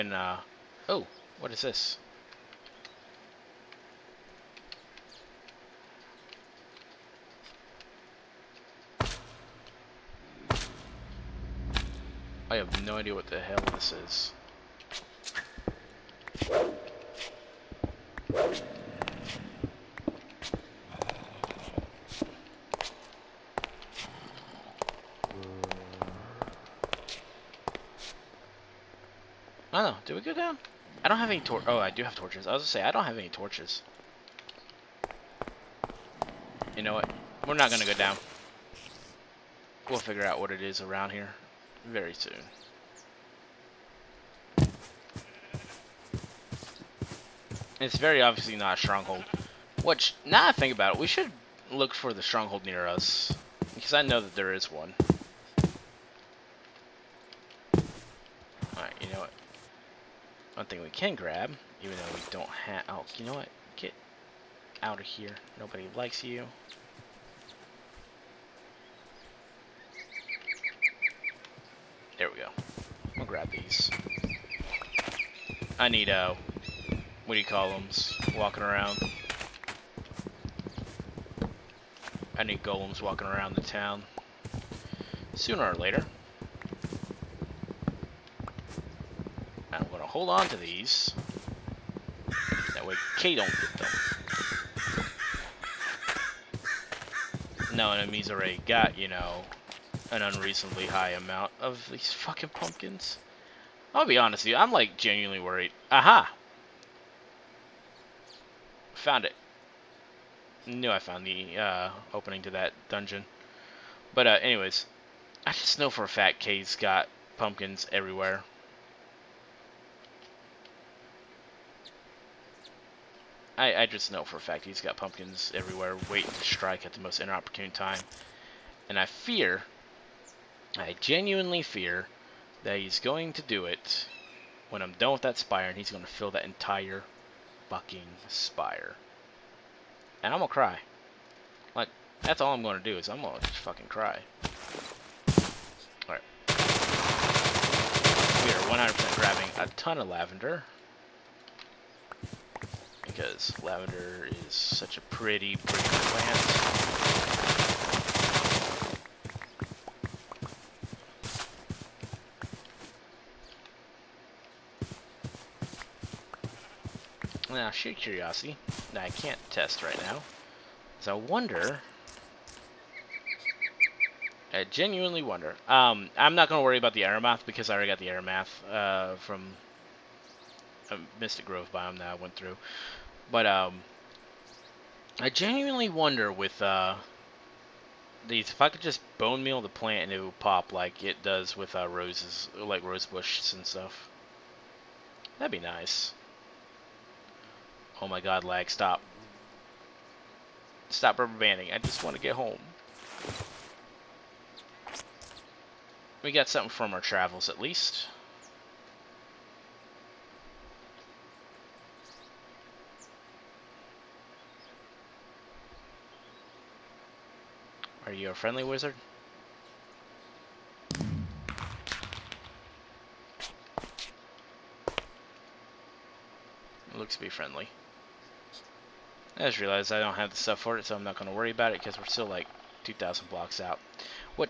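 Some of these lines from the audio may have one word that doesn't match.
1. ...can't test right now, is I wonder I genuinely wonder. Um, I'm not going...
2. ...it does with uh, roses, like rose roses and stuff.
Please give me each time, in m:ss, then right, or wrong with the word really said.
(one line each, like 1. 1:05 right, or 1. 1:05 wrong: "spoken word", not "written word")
1. 2:49 right
2. 3:11 wrong: "bushes", not "roses".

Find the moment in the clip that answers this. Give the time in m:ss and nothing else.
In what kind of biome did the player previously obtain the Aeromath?
3:01.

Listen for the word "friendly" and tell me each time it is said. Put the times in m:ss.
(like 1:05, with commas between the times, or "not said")
3:38, 3:47.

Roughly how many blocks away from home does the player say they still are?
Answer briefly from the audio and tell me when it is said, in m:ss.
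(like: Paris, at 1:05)
2,000, at 3:52.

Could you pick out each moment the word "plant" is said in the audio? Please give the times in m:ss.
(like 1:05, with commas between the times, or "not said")
2:35, 3:09.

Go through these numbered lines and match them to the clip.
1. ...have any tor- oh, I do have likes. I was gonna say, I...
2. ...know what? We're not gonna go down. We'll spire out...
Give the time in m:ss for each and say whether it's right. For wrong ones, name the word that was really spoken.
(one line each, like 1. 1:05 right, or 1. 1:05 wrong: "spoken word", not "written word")
1. 0:31 wrong: "torches", not "likes"
2. 0:36 wrong: "figure", not "spire".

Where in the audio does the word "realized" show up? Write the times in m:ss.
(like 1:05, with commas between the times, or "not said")
3:49.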